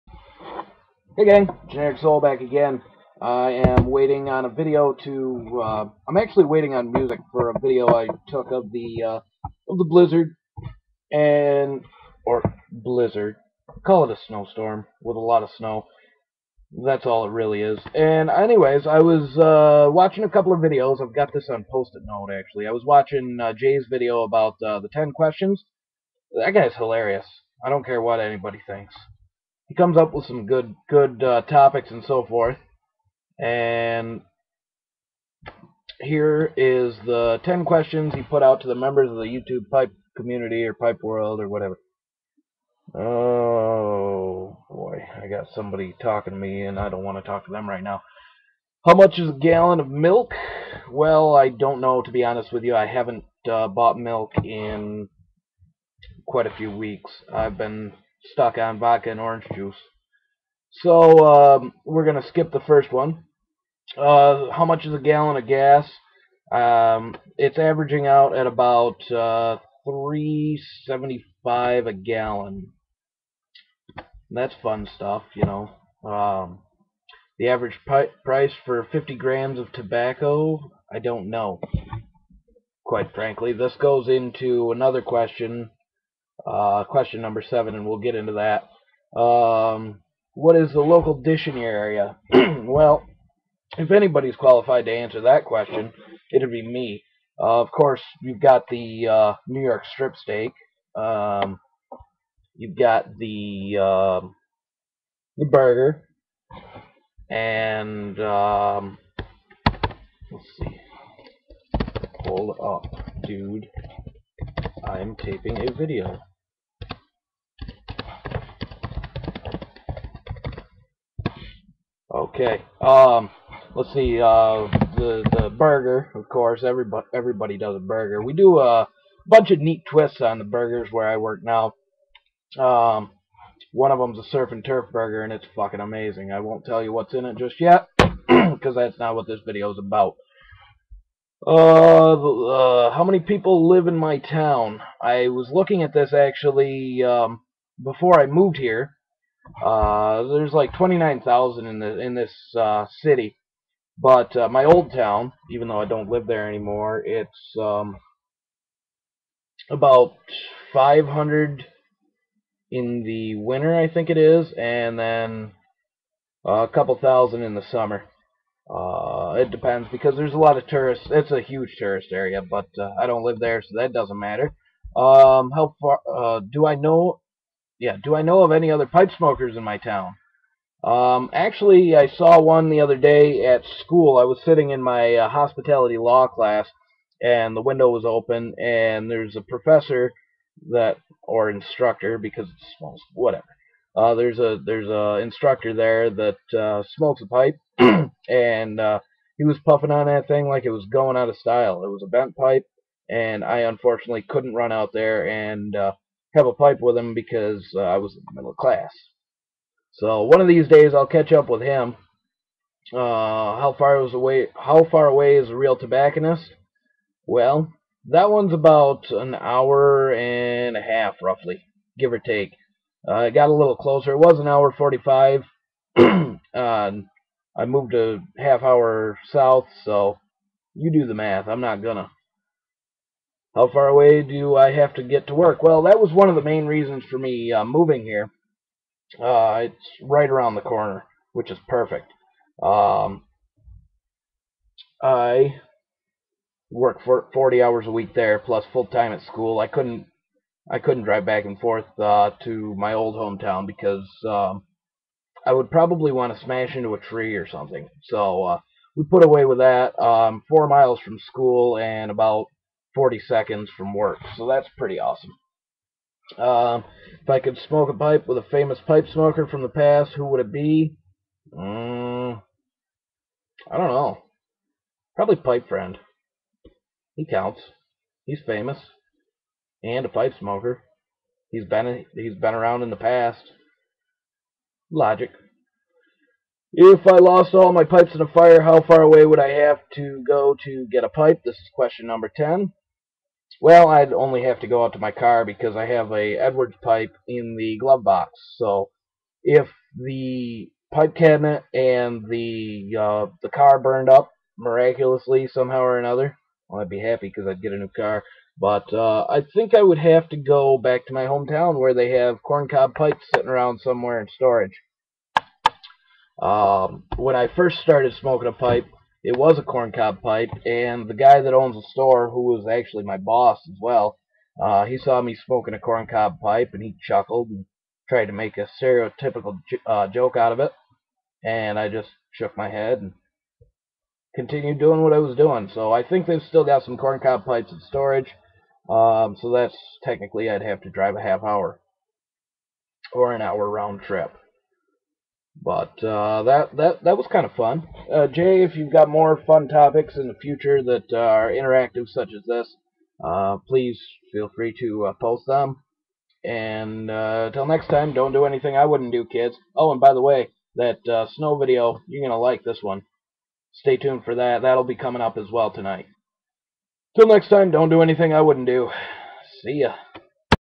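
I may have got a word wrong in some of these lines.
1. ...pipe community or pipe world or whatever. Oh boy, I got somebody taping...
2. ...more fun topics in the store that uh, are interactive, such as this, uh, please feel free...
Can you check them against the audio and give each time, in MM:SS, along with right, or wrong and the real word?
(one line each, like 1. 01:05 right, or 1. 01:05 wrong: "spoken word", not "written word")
1. 00:39 wrong: "talking", not "taping"
2. 05:49 wrong: "future", not "store".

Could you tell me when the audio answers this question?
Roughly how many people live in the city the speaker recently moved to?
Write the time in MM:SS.
02:30.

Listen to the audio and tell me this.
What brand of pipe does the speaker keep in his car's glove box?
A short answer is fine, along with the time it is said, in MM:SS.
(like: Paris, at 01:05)
Edwards, at 04:56.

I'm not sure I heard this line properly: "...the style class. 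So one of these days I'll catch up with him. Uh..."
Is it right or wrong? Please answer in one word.
wrong.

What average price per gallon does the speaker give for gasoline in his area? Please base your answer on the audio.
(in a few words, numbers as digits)
$3.75.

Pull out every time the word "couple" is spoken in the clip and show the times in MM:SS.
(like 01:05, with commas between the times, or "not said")
00:20, 02:46.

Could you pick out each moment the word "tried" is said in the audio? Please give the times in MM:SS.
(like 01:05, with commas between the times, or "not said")
05:28.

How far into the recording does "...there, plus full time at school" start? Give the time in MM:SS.
04:08.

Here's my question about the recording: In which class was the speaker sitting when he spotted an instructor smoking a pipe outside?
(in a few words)
hospitality law.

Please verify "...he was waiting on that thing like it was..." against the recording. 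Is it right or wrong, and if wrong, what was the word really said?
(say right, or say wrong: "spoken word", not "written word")
wrong: "puffing", not "waiting".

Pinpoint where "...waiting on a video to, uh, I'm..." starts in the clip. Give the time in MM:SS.
00:03.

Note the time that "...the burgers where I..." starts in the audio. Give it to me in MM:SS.
02:10.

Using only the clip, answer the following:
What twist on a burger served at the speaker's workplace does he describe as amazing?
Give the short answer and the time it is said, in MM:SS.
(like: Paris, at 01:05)
surf and turf burger, at 02:14.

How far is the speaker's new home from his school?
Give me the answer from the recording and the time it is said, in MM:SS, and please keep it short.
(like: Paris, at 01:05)
4 miles, at 04:20.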